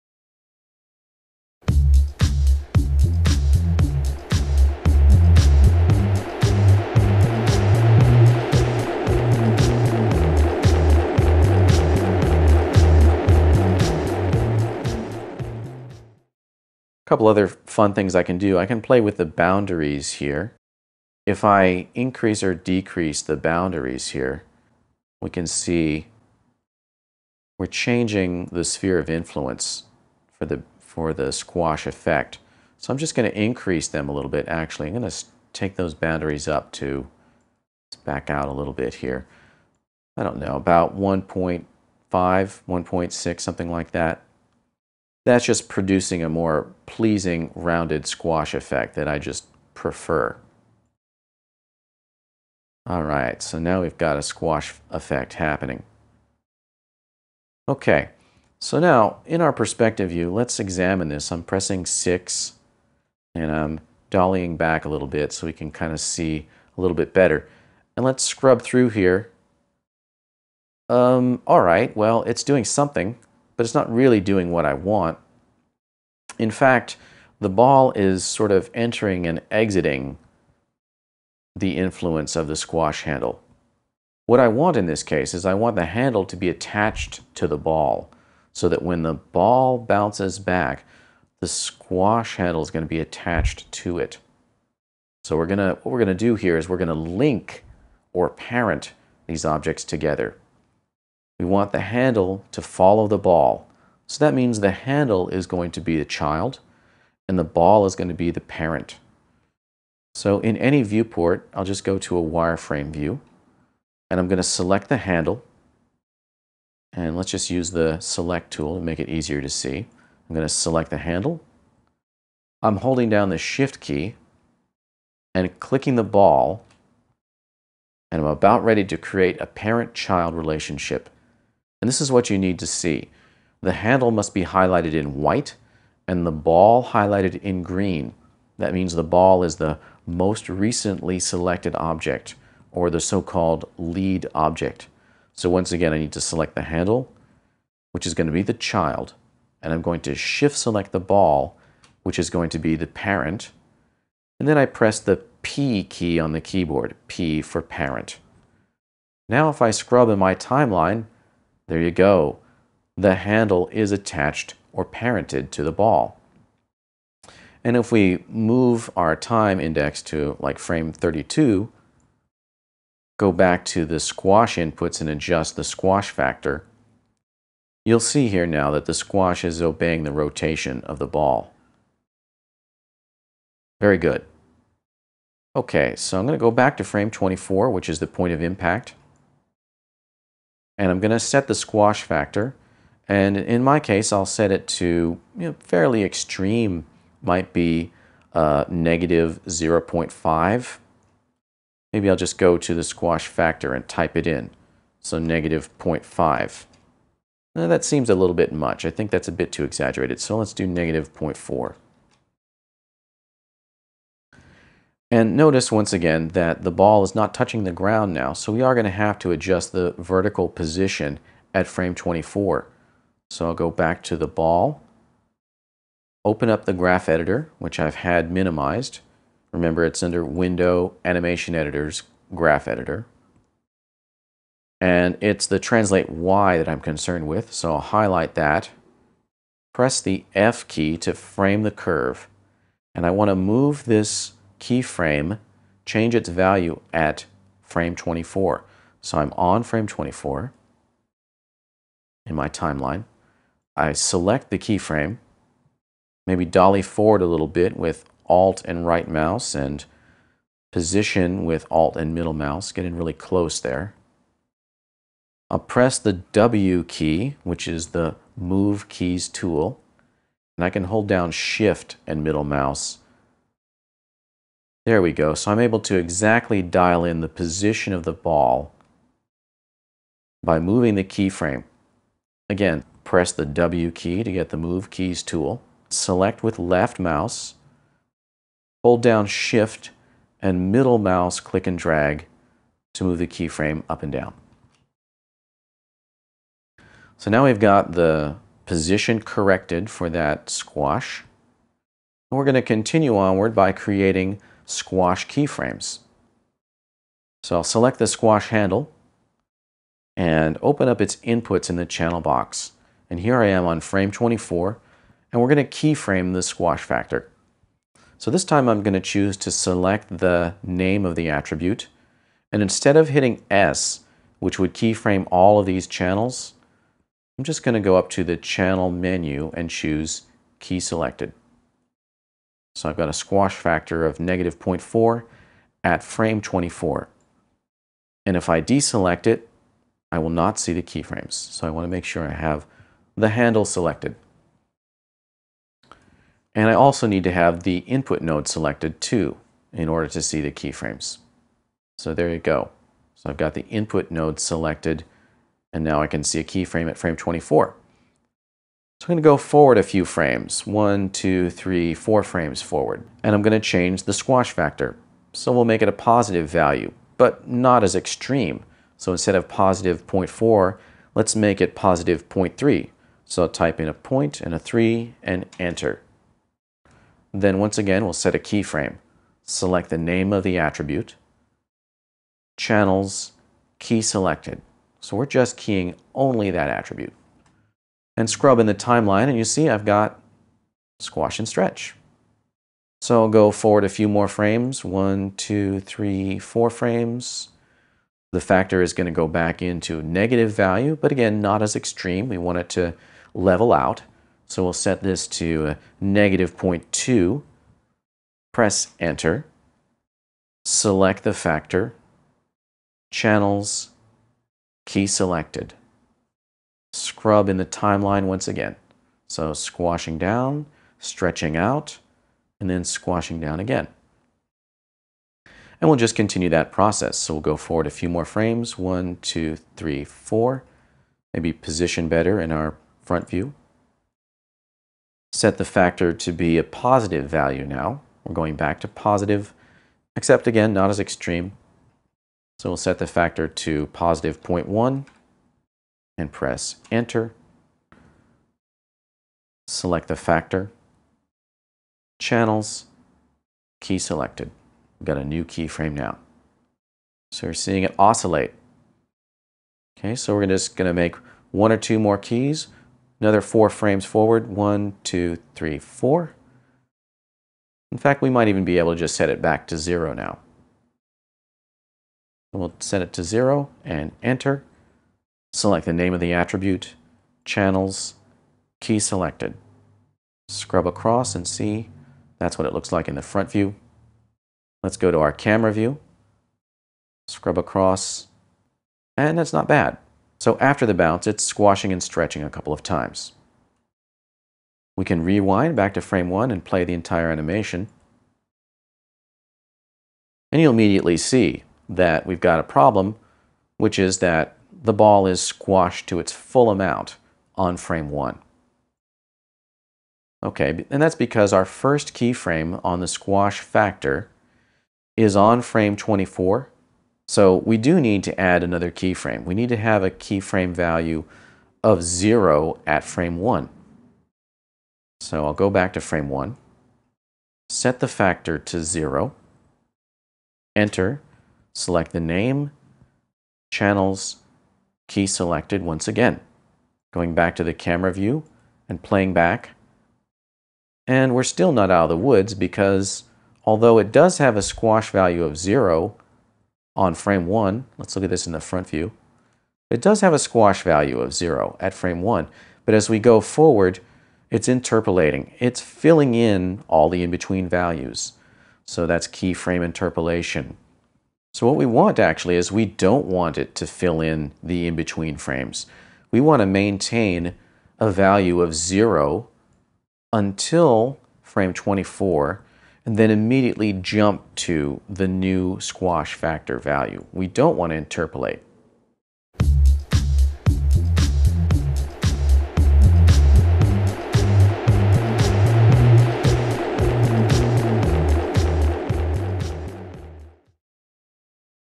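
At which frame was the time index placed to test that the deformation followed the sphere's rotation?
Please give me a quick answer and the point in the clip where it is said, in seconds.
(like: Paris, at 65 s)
32, at 170 s.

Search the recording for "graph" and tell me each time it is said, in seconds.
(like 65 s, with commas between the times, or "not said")
226 s, 232 s.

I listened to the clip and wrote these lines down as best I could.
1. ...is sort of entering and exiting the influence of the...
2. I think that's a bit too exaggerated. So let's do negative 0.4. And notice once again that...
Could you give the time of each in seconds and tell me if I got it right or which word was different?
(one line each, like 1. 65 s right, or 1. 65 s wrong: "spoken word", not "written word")
1. 77 s right
2. 208 s right.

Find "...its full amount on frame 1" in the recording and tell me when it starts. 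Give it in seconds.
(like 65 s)
506 s.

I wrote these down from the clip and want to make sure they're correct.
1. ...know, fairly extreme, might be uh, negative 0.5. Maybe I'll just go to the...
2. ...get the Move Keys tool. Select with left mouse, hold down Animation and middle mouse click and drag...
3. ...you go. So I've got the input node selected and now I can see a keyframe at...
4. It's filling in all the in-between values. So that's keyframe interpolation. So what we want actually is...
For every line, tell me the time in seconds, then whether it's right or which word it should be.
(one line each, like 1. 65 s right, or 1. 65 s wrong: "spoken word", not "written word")
1. 195 s right
2. 284 s wrong: "Shift", not "Animation"
3. 352 s right
4. 555 s right.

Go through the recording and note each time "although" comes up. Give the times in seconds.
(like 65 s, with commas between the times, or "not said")
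543 s.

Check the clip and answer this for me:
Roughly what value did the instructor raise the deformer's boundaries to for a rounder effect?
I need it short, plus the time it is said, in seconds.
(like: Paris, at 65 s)
1.5 to 1.6, at 40 s.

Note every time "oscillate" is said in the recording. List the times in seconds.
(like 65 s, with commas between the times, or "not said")
457 s.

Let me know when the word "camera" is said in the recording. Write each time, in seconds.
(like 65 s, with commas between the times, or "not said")
485 s, 537 s.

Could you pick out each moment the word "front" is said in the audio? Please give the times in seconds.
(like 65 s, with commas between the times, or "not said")
433 s, 483 s, 548 s.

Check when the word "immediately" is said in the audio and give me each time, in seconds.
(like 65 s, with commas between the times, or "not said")
500 s, 573 s.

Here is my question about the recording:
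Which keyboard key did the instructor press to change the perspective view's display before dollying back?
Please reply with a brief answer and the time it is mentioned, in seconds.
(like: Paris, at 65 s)
6, at 61 s.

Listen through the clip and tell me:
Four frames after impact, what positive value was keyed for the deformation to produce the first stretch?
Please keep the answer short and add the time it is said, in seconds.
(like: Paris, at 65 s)
0.3, at 371 s.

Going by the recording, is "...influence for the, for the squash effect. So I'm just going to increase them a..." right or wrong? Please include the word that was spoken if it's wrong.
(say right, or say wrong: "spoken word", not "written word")
right.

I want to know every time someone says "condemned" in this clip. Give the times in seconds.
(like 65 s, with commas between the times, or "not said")
not said.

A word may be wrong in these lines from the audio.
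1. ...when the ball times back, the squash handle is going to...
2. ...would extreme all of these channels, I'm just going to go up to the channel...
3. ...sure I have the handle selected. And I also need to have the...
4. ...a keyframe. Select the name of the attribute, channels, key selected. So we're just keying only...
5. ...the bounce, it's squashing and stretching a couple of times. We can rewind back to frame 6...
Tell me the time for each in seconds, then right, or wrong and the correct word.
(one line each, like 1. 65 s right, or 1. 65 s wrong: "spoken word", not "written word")
1. 88 s wrong: "bounces", not "times"
2. 324 s wrong: "keyframe", not "extreme"
3. 342 s right
4. 378 s right
5. 490 s wrong: "1", not "6".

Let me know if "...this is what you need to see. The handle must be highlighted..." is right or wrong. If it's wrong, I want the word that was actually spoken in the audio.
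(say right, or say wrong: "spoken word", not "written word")
right.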